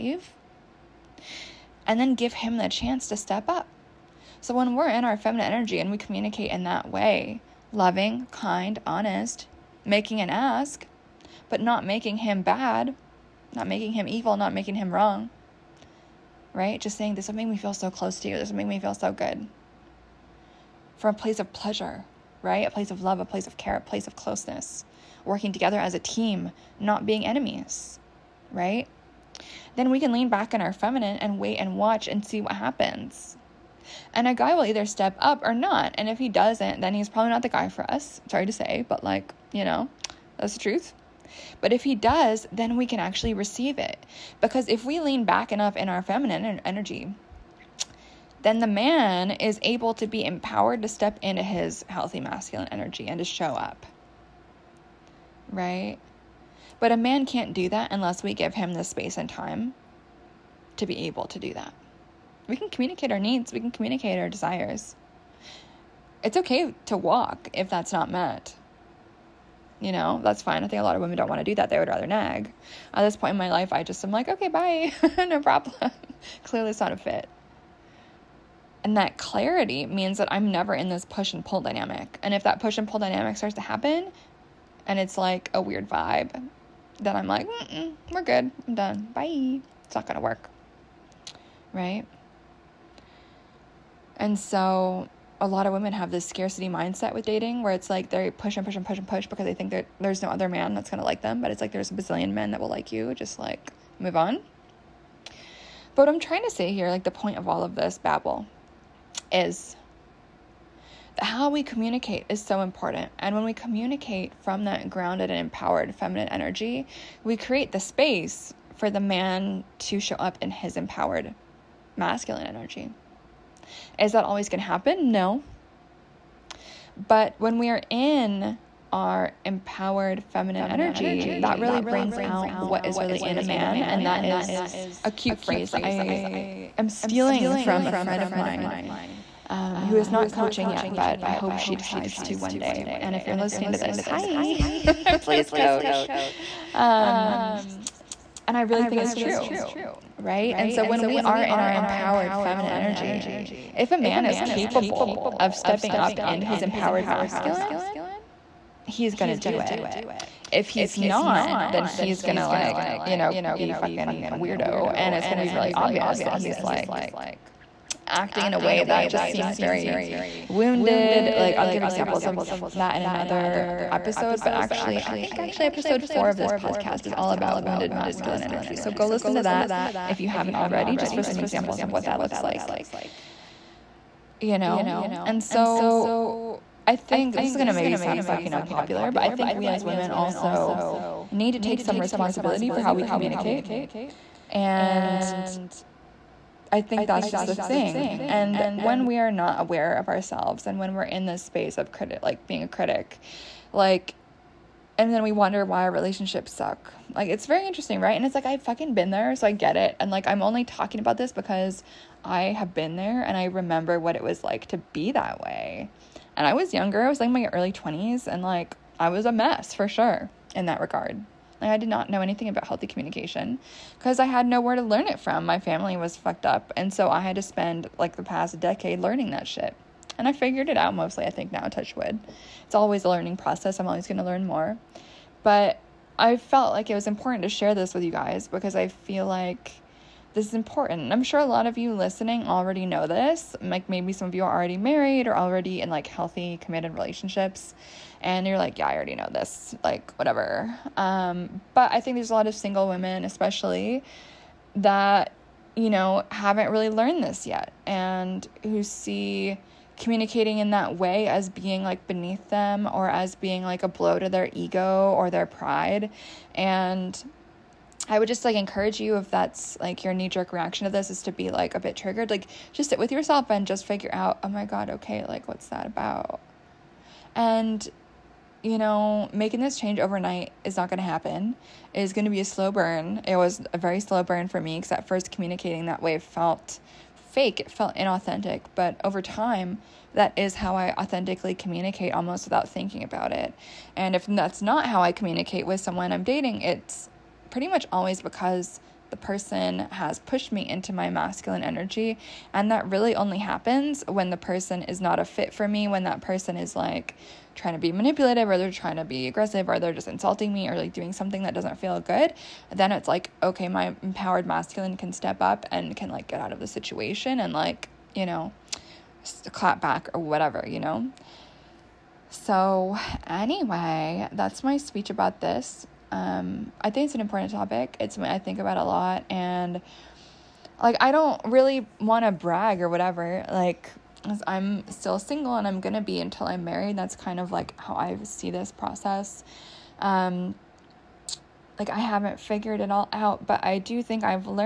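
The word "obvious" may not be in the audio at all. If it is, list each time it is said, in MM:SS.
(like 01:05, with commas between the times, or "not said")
02:45.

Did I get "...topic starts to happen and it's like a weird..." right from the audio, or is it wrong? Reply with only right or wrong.
wrong.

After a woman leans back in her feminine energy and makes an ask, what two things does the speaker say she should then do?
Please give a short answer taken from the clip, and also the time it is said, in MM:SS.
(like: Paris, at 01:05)
Wait and watch, at 00:31.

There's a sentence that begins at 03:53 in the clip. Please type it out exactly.
I'm always going to learn more.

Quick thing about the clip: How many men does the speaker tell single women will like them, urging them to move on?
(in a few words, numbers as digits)
A bazillion.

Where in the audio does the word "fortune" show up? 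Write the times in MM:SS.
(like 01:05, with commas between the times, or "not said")
not said.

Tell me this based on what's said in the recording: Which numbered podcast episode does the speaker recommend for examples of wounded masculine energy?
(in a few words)
Episode 4.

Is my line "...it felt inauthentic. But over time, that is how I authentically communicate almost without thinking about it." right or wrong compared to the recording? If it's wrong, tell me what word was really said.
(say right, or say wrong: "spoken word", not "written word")
right.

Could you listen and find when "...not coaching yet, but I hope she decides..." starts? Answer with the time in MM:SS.
02:20.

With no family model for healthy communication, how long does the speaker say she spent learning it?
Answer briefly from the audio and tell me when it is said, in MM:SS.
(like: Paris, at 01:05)
The past decade, at 03:48.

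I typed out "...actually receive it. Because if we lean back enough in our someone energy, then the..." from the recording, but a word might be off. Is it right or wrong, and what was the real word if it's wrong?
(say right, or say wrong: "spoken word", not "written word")
wrong: "feminine", not "someone".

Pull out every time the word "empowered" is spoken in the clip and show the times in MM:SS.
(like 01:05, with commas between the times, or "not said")
00:50, 01:55, 02:00, 02:09, 02:31, 02:36, 05:14.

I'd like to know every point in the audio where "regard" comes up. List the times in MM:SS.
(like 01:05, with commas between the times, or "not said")
03:40.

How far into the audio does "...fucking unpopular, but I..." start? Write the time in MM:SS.
03:08.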